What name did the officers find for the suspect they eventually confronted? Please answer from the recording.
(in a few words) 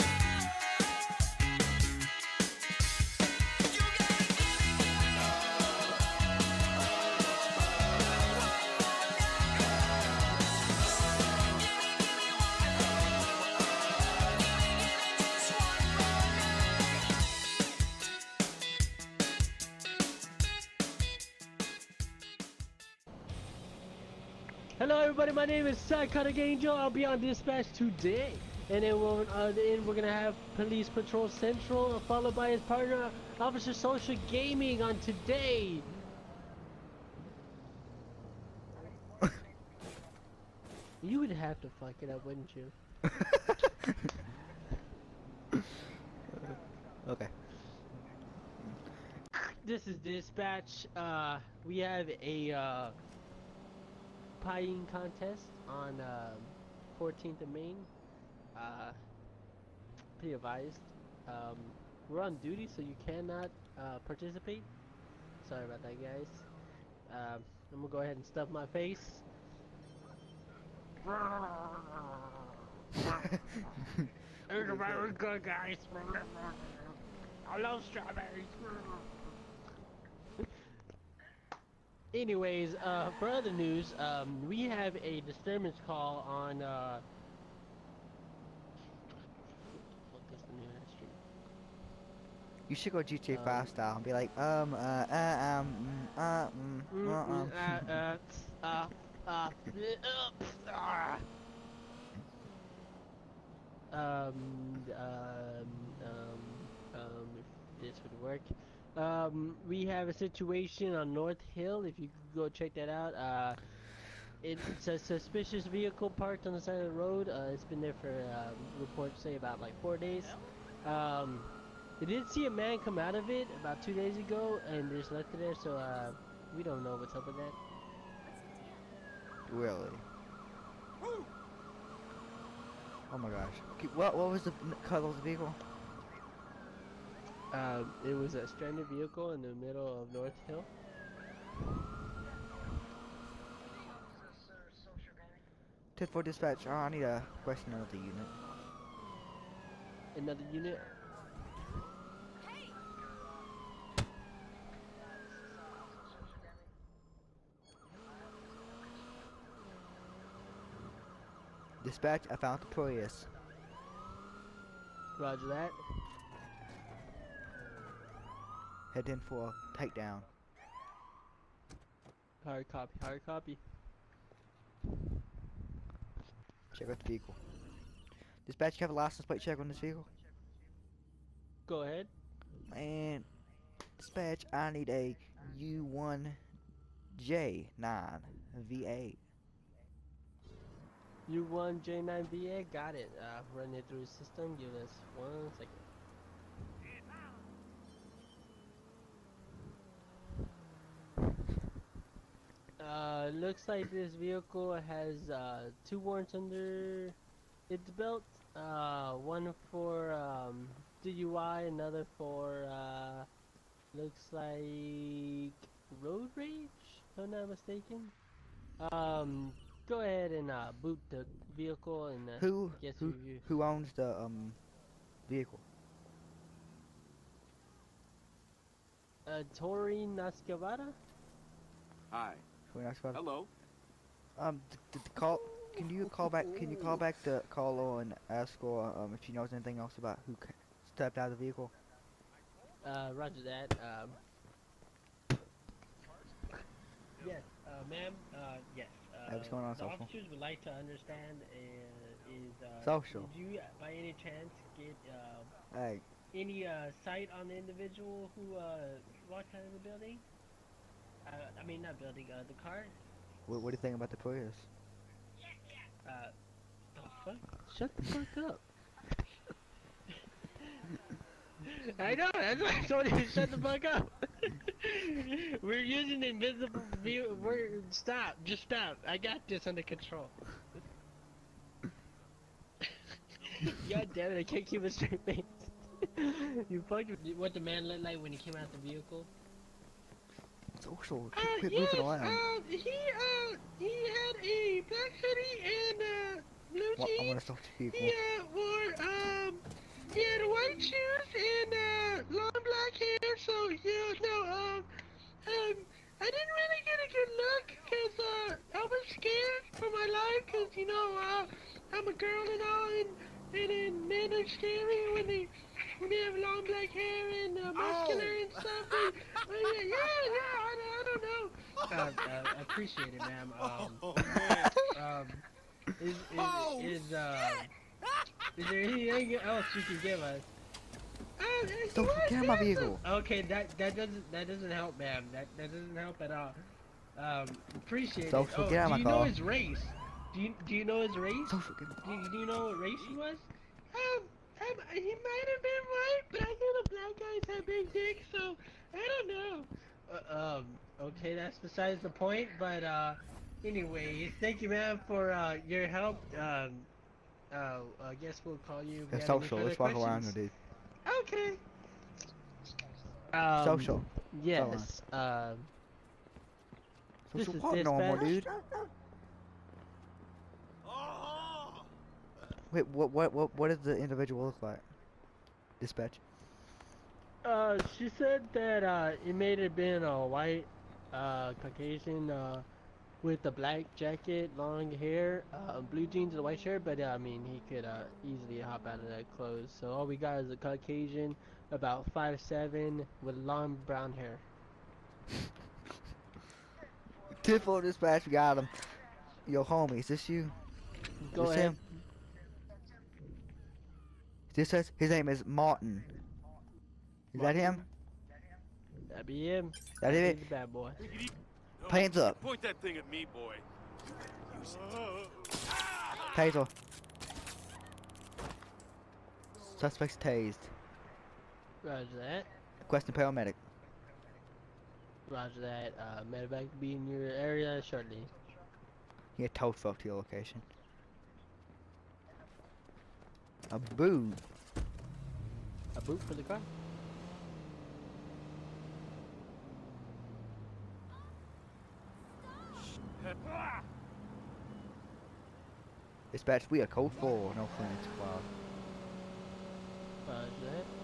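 Martin.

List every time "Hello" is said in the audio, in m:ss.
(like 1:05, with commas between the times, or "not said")
0:24, 3:53.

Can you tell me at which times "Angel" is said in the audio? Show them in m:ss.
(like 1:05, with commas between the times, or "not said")
0:26.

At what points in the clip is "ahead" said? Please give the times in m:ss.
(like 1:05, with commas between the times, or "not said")
1:08, 3:01, 3:40, 6:41.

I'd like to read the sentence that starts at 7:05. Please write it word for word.
Uh, medivac be in your area shortly.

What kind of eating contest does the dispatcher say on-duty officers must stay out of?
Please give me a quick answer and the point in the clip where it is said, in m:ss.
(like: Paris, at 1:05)
Pie eating contest, at 0:54.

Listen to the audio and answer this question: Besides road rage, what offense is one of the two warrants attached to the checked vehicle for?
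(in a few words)
DUI.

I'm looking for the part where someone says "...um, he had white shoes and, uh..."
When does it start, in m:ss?
4:59.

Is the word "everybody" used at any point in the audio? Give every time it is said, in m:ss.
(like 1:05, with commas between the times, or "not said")
0:25.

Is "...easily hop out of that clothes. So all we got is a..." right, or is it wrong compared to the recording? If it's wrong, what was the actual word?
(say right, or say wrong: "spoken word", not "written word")
right.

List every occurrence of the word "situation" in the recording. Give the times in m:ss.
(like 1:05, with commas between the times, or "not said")
1:50.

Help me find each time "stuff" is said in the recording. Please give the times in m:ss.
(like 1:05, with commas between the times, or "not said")
1:08, 5:18.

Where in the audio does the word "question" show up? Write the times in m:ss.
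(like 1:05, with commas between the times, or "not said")
2:27, 7:02.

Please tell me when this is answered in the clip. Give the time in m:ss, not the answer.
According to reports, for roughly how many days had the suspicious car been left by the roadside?
1:59.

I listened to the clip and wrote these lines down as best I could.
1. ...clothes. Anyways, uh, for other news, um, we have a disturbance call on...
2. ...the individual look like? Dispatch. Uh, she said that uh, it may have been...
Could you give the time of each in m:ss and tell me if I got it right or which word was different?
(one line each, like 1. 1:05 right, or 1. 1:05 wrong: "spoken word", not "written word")
1. 1:17 wrong: "strawberries", not "clothes"
2. 6:13 right.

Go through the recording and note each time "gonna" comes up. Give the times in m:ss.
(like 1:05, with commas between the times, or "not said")
0:29, 1:07.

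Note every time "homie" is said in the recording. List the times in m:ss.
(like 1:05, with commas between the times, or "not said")
6:39.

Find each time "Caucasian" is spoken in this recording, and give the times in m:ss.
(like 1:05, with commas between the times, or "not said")
6:21, 6:30.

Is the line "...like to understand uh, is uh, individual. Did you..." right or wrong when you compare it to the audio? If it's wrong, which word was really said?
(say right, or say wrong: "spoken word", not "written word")
wrong: "social", not "individual".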